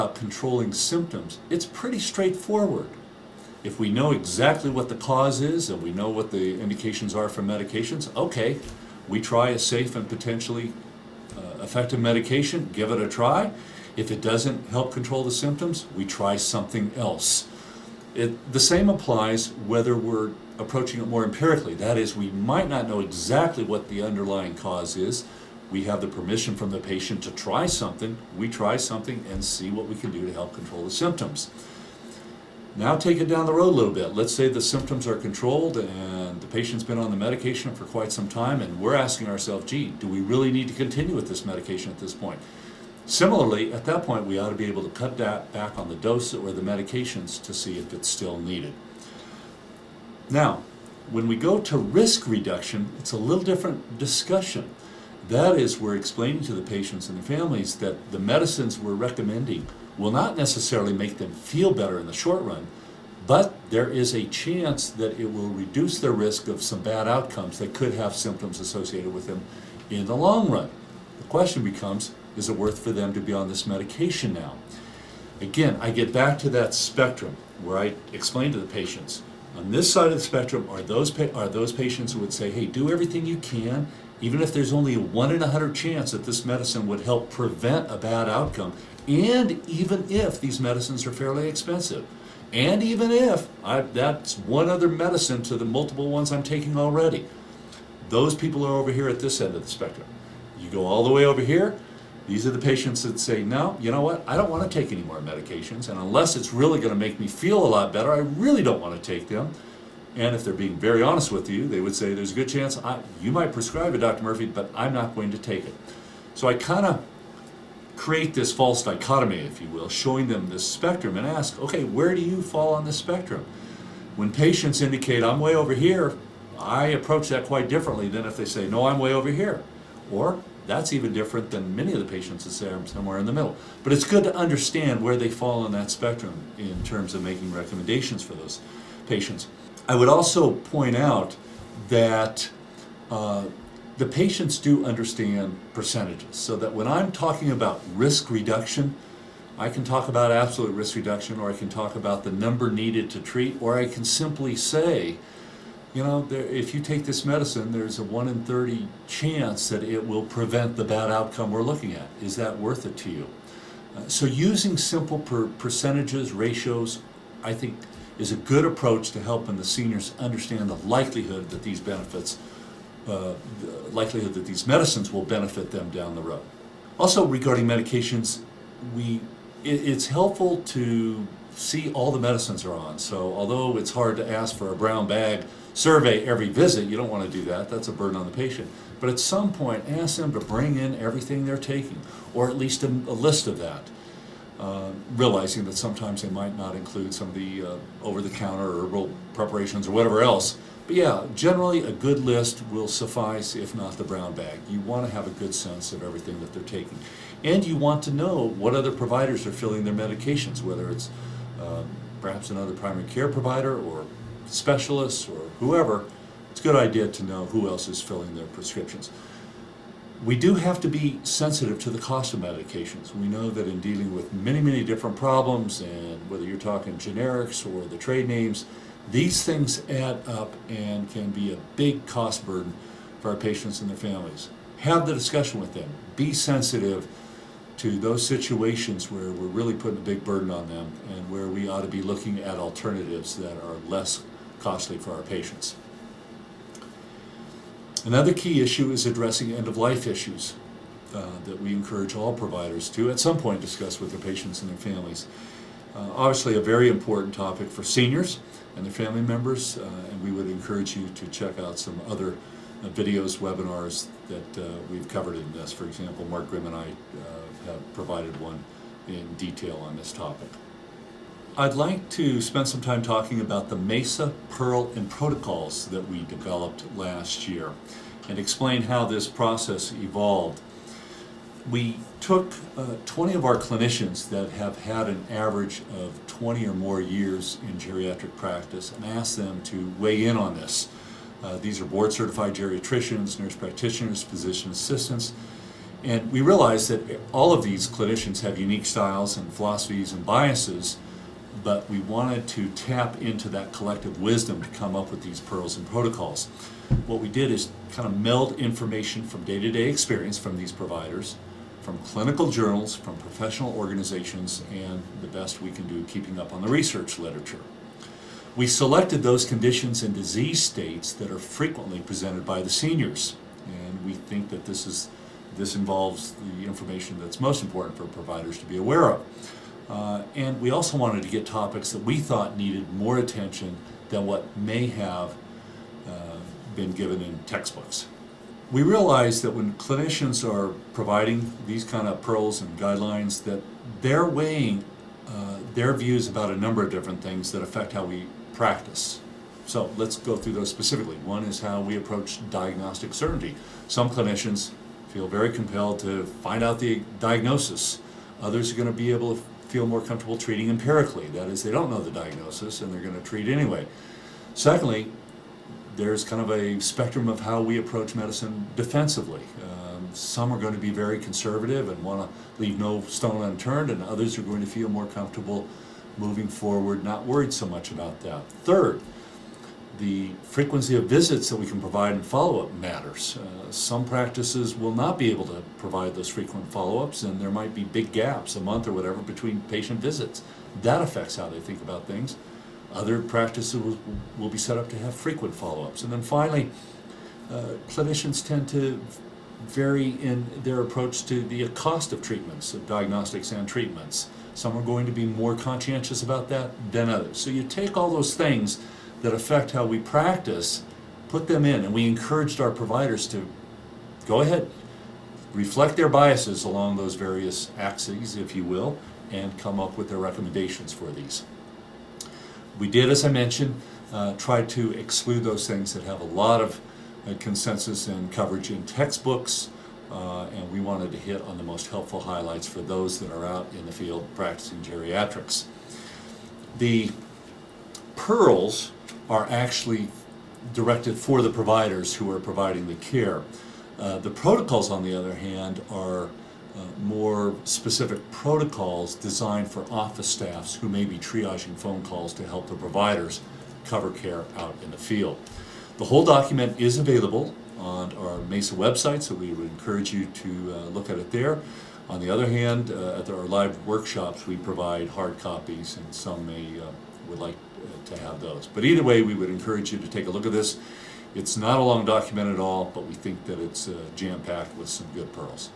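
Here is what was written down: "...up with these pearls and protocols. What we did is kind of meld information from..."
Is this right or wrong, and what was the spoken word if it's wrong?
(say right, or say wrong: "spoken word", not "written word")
right.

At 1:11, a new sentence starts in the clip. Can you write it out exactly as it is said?
The question becomes, is it worth for them to be on this medication now?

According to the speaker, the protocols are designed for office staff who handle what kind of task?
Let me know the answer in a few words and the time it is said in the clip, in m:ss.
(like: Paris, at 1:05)
triaging phone calls, at 7:31.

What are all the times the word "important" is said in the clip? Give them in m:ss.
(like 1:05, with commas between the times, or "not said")
4:16, 5:27.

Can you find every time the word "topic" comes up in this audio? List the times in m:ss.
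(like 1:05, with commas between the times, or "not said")
4:17, 4:30, 5:31.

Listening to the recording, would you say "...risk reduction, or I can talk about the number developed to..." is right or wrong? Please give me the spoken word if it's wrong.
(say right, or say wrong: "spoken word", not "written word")
wrong: "needed", not "developed".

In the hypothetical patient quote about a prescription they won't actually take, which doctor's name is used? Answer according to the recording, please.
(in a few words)
Dr. Murphy.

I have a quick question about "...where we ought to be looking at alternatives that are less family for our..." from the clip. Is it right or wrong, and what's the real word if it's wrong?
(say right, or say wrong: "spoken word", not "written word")
wrong: "costly", not "family".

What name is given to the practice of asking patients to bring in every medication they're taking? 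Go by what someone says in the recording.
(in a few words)
brown bag survey.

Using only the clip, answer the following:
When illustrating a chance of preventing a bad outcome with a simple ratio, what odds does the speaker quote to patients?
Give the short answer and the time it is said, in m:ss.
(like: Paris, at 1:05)
1 in 30, at 2:38.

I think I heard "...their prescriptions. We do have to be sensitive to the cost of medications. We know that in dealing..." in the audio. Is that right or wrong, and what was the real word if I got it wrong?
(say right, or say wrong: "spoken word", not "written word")
right.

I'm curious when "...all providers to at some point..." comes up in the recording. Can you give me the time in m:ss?
4:12.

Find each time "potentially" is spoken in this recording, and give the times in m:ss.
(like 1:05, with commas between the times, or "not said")
0:10.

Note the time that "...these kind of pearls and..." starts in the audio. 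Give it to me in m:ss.
5:41.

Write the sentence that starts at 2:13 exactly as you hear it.
But it's good to understand where they fall on that spectrum in terms of making recommendations for those patients.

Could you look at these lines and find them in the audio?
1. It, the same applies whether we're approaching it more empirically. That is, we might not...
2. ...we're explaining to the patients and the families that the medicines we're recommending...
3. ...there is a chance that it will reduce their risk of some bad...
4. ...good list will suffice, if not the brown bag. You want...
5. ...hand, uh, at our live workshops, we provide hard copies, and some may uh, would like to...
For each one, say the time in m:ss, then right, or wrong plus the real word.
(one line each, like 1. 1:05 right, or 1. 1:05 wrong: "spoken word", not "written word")
1. 0:18 right
2. 0:55 right
3. 1:03 right
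4. 3:21 right
5. 7:42 right.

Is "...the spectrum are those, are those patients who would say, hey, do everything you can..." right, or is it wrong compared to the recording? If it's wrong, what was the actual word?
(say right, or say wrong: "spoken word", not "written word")
right.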